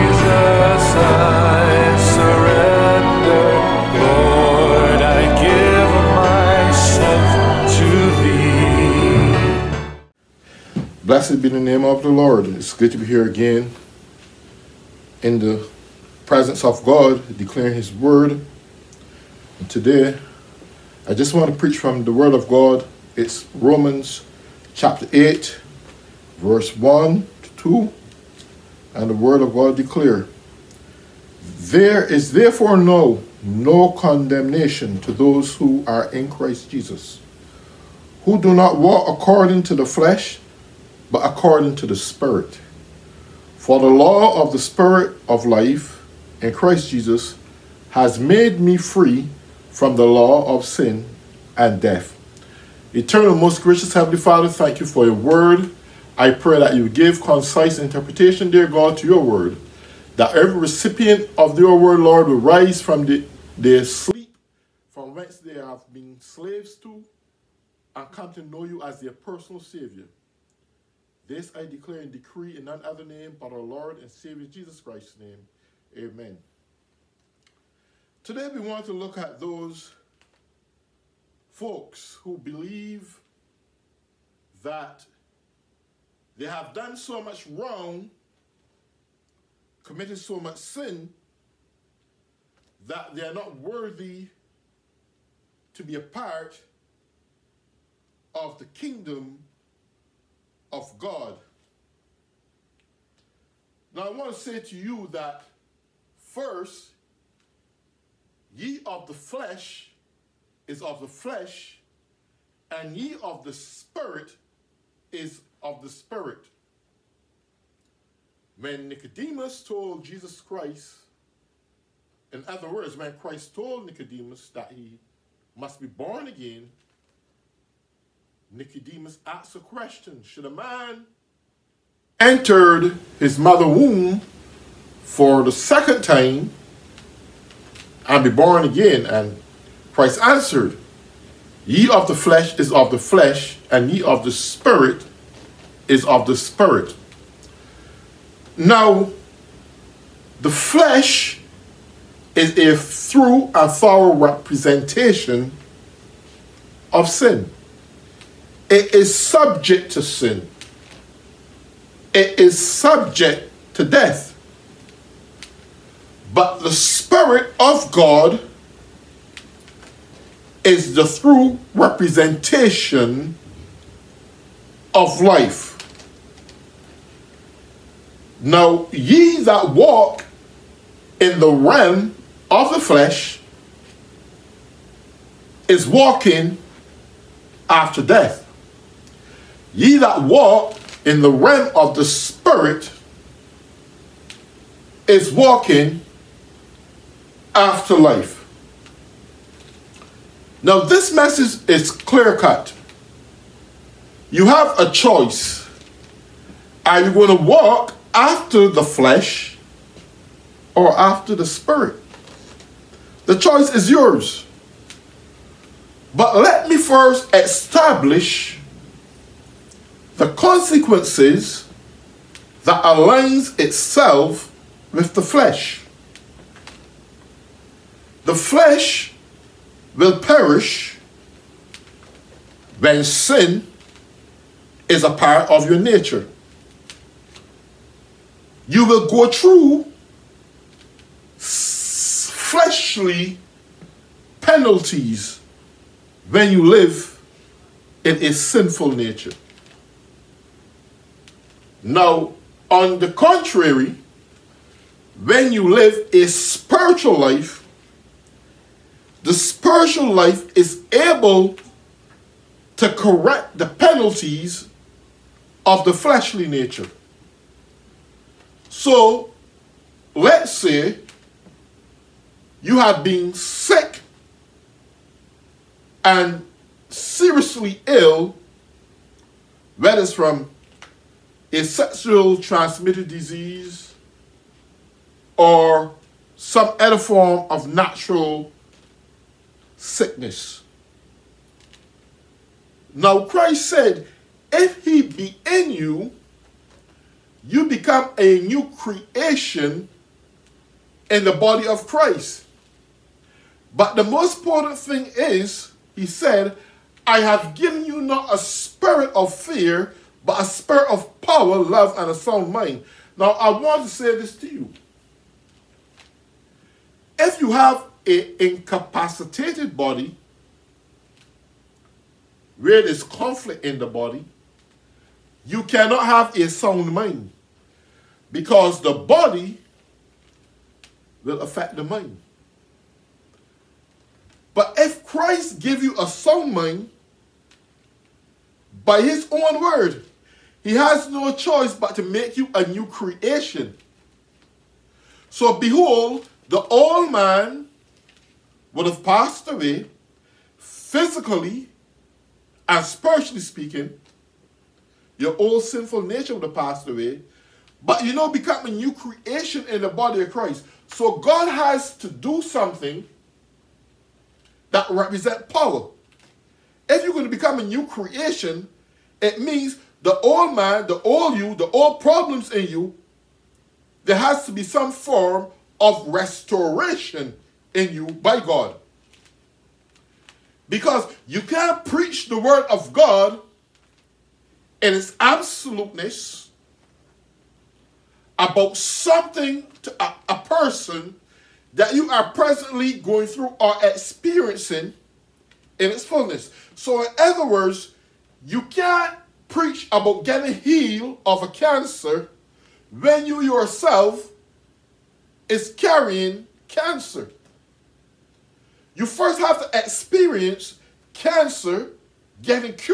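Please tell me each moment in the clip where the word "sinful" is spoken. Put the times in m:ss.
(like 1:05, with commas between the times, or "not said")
4:08, 5:55.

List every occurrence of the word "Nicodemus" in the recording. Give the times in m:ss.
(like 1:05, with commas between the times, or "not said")
1:58, 2:03, 2:08.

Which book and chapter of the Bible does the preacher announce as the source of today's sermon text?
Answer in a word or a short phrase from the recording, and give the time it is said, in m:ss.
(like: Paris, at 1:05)
Romans chapter 8, at 0:23.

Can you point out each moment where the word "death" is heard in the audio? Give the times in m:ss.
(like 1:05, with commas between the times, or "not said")
0:51, 2:43, 3:08.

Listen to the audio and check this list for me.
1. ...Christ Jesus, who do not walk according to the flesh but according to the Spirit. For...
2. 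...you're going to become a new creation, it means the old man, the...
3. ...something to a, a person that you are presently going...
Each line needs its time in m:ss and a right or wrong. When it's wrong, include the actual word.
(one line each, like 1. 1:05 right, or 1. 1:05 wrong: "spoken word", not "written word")
1. 0:36 right
2. 6:07 right
3. 6:28 right.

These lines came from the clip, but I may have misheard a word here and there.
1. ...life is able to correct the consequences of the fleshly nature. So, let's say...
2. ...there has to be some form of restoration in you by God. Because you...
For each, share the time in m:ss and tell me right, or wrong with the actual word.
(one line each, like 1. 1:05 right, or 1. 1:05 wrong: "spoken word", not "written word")
1. 4:20 wrong: "penalties", not "consequences"
2. 6:14 right.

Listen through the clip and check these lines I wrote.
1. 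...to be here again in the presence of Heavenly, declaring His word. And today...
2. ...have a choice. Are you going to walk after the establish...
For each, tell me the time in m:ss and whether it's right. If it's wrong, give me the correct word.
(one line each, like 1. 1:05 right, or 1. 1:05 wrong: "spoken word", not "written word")
1. 0:12 wrong: "God", not "Heavenly"
2. 3:24 wrong: "flesh", not "establish".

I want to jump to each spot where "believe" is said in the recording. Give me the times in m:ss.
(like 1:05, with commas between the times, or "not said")
1:22.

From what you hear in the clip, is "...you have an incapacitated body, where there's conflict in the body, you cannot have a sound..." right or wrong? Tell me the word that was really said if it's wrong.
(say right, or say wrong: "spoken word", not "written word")
right.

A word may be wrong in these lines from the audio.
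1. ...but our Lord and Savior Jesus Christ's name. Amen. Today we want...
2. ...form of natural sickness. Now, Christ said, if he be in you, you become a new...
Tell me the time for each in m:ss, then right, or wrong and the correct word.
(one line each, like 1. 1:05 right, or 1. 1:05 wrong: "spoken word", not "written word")
1. 1:13 right
2. 4:46 right.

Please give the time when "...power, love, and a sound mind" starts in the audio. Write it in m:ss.
5:11.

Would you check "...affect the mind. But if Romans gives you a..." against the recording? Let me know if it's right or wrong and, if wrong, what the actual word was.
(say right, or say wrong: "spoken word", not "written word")
wrong: "Christ", not "Romans".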